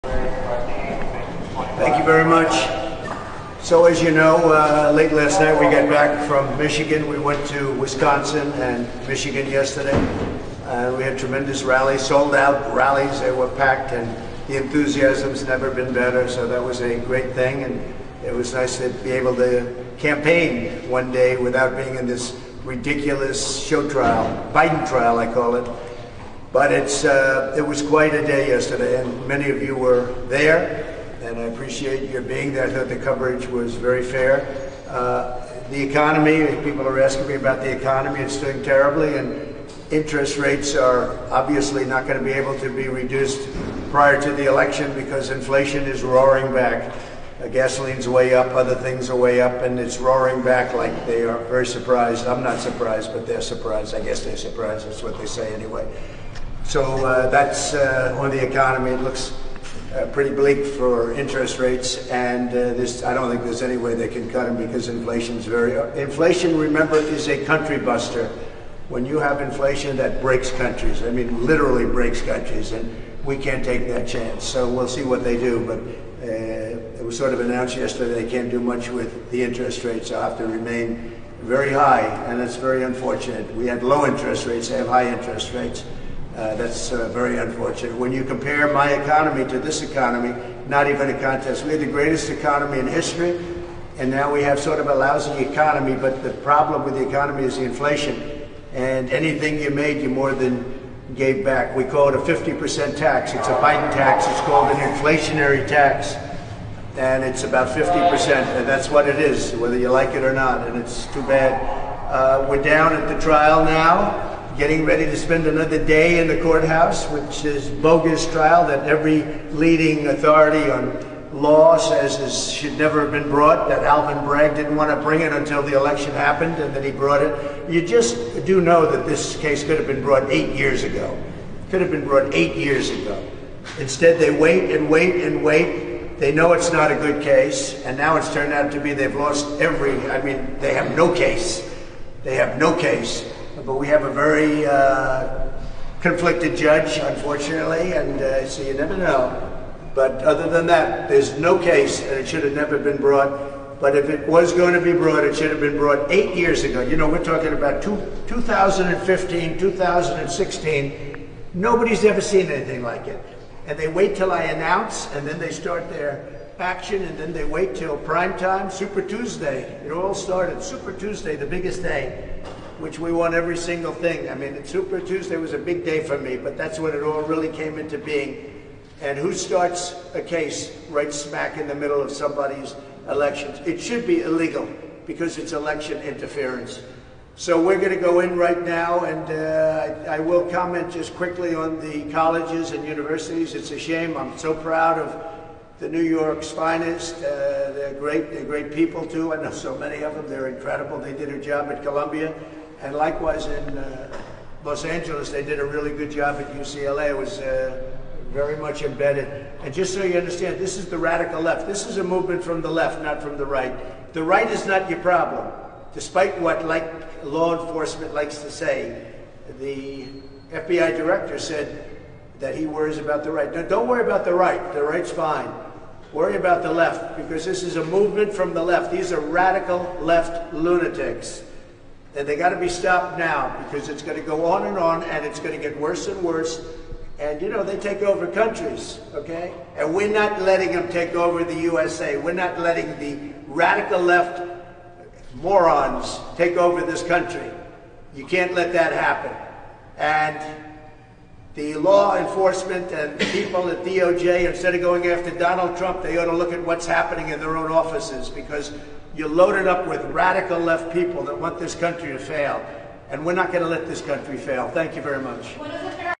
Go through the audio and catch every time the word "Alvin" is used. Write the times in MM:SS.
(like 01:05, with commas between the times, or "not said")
02:03.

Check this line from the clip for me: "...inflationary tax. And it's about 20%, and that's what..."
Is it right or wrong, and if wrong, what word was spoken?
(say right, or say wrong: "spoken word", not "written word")
wrong: "50", not "20".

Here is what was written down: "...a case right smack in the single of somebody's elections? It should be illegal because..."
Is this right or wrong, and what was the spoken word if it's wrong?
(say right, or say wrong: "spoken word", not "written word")
wrong: "middle", not "single".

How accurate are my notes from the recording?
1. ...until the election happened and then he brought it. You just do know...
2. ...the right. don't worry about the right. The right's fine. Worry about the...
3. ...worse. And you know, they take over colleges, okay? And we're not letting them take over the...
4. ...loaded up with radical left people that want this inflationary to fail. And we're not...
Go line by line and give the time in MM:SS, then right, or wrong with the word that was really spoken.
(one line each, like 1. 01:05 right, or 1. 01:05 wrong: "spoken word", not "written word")
1. 02:05 right
2. 03:43 right
3. 03:56 wrong: "countries", not "colleges"
4. 04:19 wrong: "country", not "inflationary".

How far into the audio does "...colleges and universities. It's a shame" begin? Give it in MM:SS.
03:12.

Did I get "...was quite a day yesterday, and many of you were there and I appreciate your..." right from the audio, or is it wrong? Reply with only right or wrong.
right.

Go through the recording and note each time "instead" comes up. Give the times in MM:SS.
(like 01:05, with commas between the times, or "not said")
02:13, 04:14.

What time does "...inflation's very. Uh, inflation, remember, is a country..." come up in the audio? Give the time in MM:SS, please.
01:04.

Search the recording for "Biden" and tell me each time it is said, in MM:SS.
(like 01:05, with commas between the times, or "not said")
00:24, 01:43.